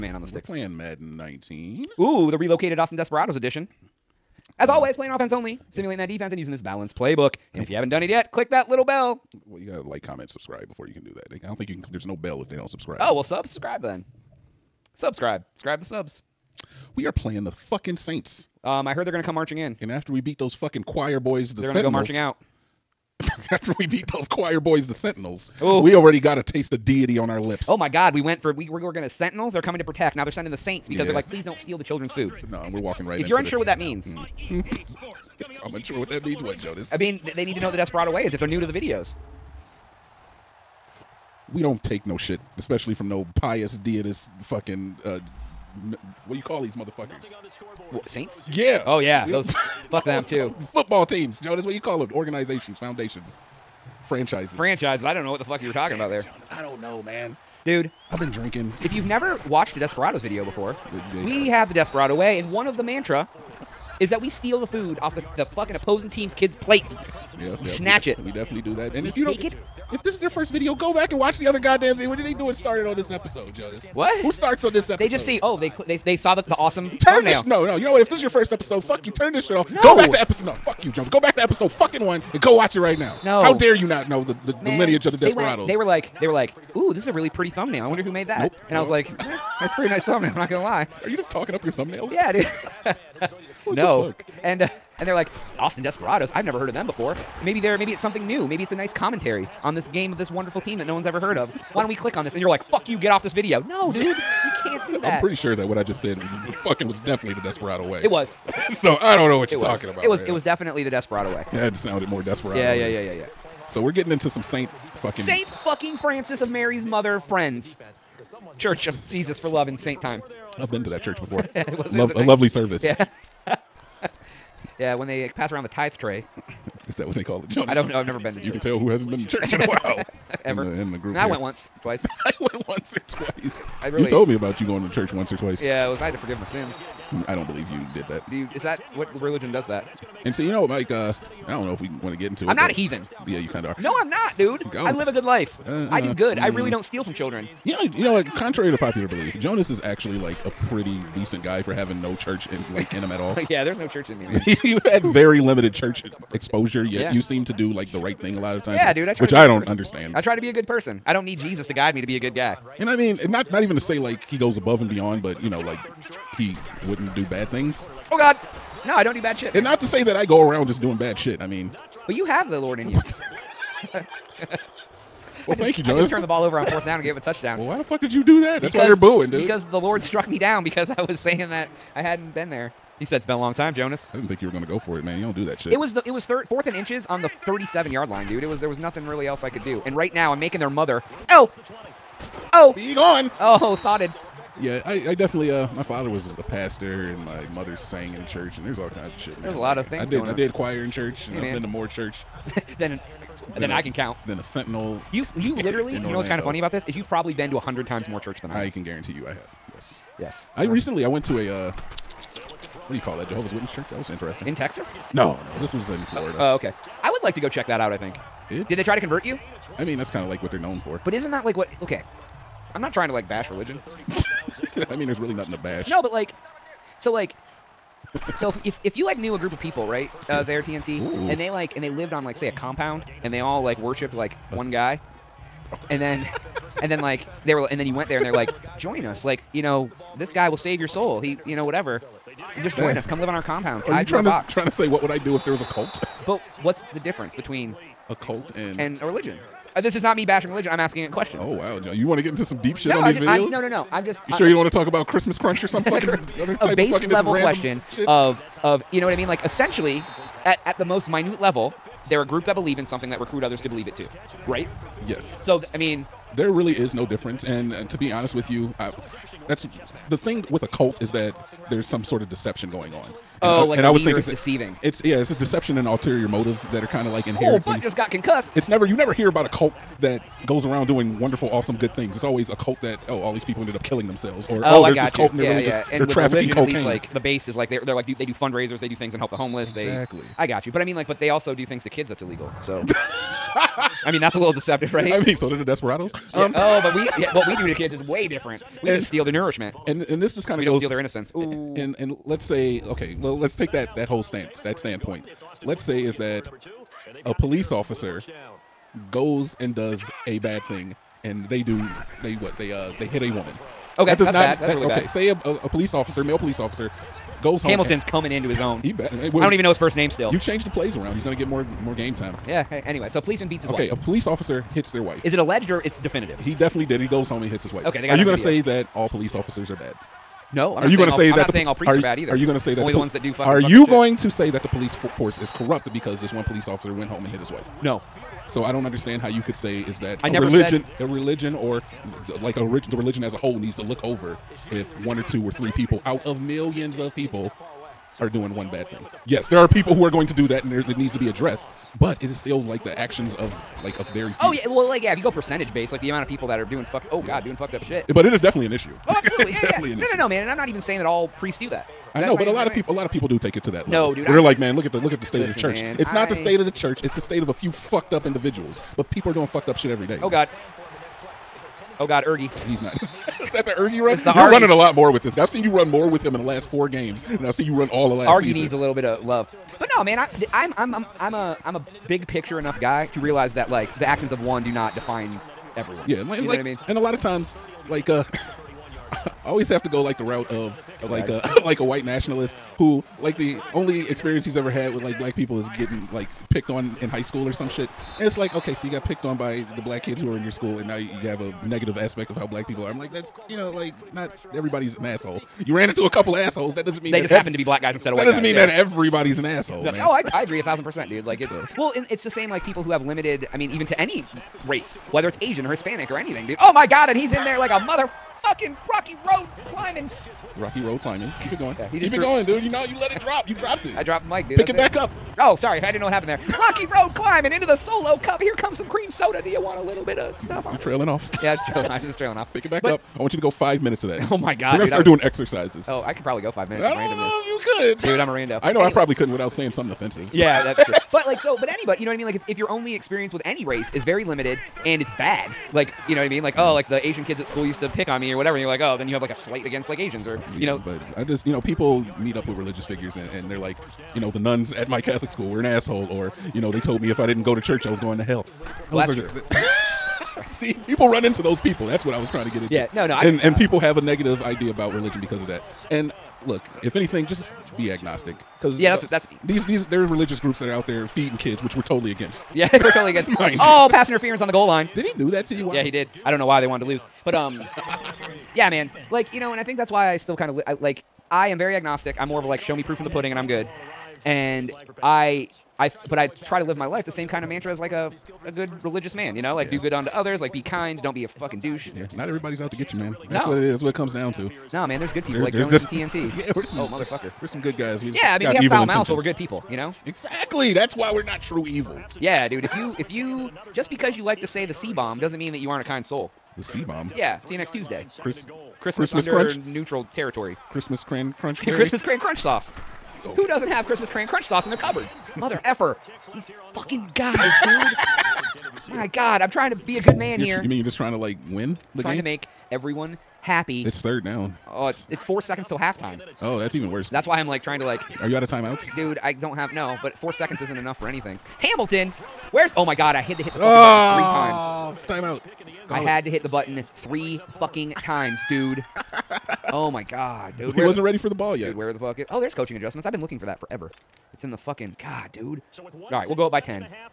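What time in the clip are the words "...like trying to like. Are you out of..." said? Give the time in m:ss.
8:47.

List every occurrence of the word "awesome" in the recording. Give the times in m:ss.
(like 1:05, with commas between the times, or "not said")
1:16, 4:41.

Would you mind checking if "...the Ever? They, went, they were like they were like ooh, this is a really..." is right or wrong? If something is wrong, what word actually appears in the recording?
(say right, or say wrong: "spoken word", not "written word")
wrong: "Desperados", not "Ever".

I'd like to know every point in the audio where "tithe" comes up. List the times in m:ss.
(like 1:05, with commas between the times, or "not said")
2:05.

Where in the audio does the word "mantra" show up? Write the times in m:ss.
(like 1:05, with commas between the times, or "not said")
1:02, 8:07.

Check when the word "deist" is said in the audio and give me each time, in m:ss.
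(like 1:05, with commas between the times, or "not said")
0:43.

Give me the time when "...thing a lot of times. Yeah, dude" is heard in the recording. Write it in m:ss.
2:38.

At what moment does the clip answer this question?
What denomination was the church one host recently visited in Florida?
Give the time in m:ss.
3:33.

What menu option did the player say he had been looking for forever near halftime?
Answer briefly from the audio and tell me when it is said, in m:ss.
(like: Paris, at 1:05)
Coaching adjustments, at 9:02.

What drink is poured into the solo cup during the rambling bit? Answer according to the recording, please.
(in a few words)
Cream soda.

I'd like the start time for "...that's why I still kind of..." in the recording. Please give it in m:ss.
7:59.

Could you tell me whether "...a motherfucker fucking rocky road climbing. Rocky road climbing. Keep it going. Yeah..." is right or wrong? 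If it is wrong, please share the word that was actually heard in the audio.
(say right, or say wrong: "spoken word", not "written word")
right.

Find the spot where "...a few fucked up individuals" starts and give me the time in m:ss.
6:07.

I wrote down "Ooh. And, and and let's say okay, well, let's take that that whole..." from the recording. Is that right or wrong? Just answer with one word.
right.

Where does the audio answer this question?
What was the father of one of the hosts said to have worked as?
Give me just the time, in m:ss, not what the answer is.
3:16.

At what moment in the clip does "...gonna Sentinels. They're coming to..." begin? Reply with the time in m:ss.
0:28.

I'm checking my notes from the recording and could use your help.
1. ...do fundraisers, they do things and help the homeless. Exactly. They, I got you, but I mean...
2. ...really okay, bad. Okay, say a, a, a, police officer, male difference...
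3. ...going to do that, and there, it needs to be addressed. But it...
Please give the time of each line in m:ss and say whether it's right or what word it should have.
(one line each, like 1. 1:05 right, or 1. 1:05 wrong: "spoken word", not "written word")
1. 4:48 right
2. 5:14 wrong: "police", not "difference"
3. 5:50 right.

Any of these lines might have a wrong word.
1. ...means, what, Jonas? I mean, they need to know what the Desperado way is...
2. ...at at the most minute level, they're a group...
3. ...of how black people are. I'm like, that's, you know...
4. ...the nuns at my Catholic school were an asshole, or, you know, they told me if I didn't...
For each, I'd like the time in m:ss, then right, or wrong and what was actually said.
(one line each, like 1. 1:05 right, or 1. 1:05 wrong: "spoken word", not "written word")
1. 0:36 right
2. 4:20 right
3. 6:42 right
4. 7:34 right.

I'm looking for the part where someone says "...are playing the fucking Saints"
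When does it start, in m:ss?
0:17.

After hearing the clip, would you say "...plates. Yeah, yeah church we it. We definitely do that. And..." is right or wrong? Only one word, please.
wrong.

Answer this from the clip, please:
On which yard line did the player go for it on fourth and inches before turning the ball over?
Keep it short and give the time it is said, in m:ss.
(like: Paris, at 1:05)
37, at 3:07.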